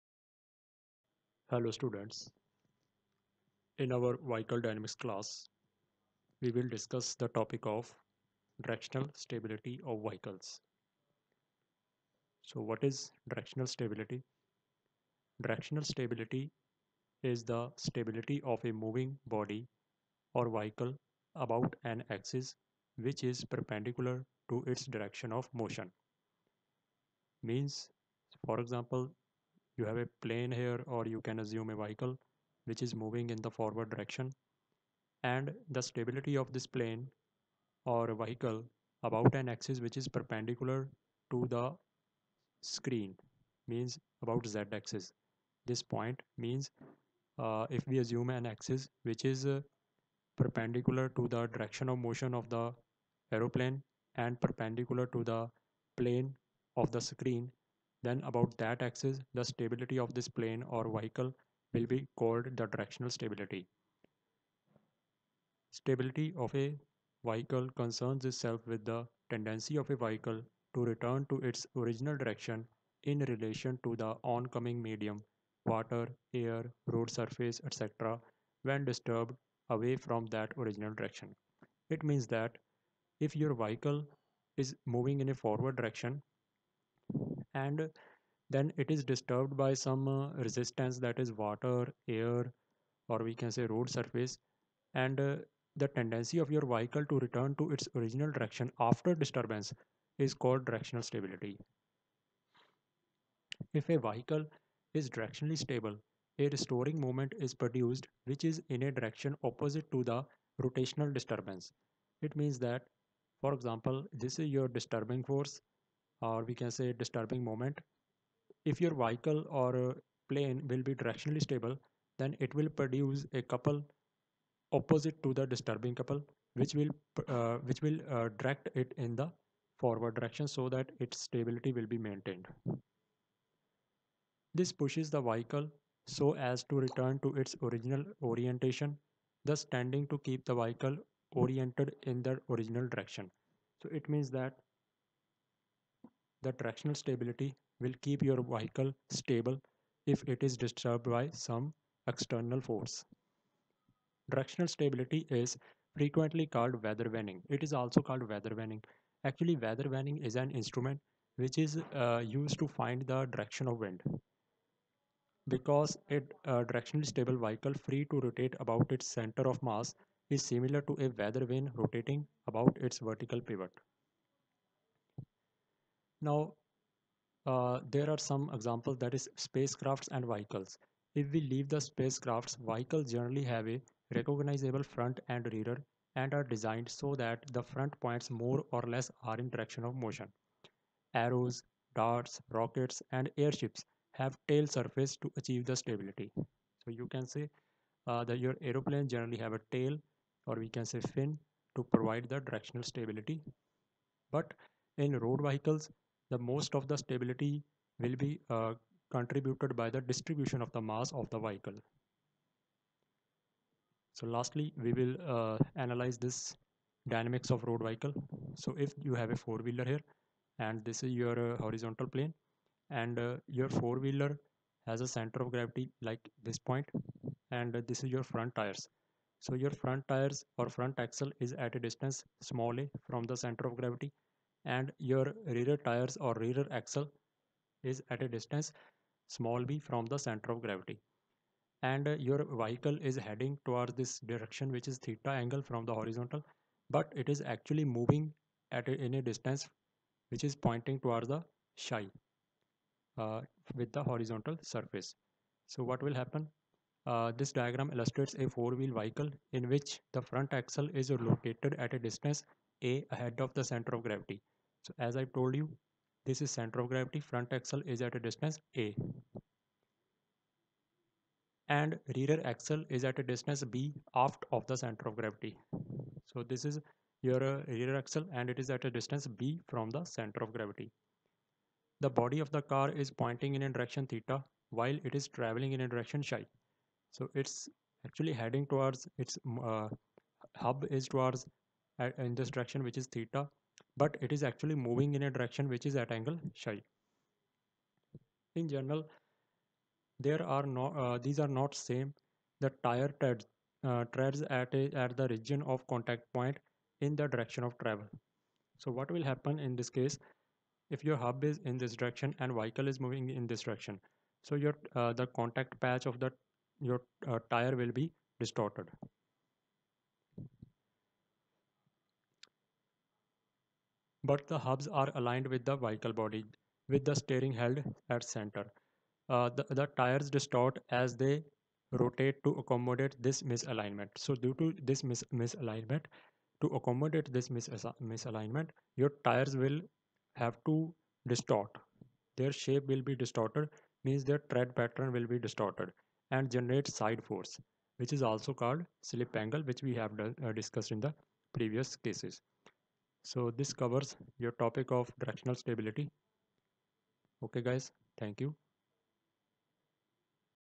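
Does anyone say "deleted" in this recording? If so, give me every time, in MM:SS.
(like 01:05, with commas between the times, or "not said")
not said.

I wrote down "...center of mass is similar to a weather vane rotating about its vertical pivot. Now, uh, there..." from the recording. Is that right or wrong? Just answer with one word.
right.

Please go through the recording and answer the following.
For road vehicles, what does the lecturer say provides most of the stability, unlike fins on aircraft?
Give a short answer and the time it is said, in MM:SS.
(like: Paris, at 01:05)
distribution of the mass, at 03:30.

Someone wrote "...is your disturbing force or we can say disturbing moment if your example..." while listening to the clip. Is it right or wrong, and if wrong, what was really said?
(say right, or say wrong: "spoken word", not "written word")
wrong: "vehicle", not "example".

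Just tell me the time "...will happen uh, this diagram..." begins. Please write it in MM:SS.
04:16.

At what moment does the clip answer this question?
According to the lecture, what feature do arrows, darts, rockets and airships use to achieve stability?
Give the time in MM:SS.
03:14.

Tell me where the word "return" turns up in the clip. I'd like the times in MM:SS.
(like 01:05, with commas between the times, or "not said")
01:10, 01:37, 02:16.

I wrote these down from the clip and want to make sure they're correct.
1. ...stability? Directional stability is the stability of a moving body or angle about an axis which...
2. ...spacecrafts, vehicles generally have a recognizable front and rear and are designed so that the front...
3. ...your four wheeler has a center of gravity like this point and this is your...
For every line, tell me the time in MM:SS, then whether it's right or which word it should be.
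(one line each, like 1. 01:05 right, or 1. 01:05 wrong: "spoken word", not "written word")
1. 00:13 wrong: "vehicle", not "angle"
2. 03:01 right
3. 03:43 right.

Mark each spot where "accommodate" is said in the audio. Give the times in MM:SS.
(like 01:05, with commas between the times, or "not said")
05:32, 05:36.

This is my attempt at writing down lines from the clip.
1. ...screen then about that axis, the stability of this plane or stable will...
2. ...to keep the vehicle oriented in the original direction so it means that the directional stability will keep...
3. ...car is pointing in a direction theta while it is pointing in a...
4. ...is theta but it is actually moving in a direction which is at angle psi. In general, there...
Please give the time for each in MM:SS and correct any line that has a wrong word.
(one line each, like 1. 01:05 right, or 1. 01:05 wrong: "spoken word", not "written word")
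1. 00:57 wrong: "vehicle", not "stable"
2. 02:20 right
3. 04:42 wrong: "traveling", not "pointing"
4. 04:52 right.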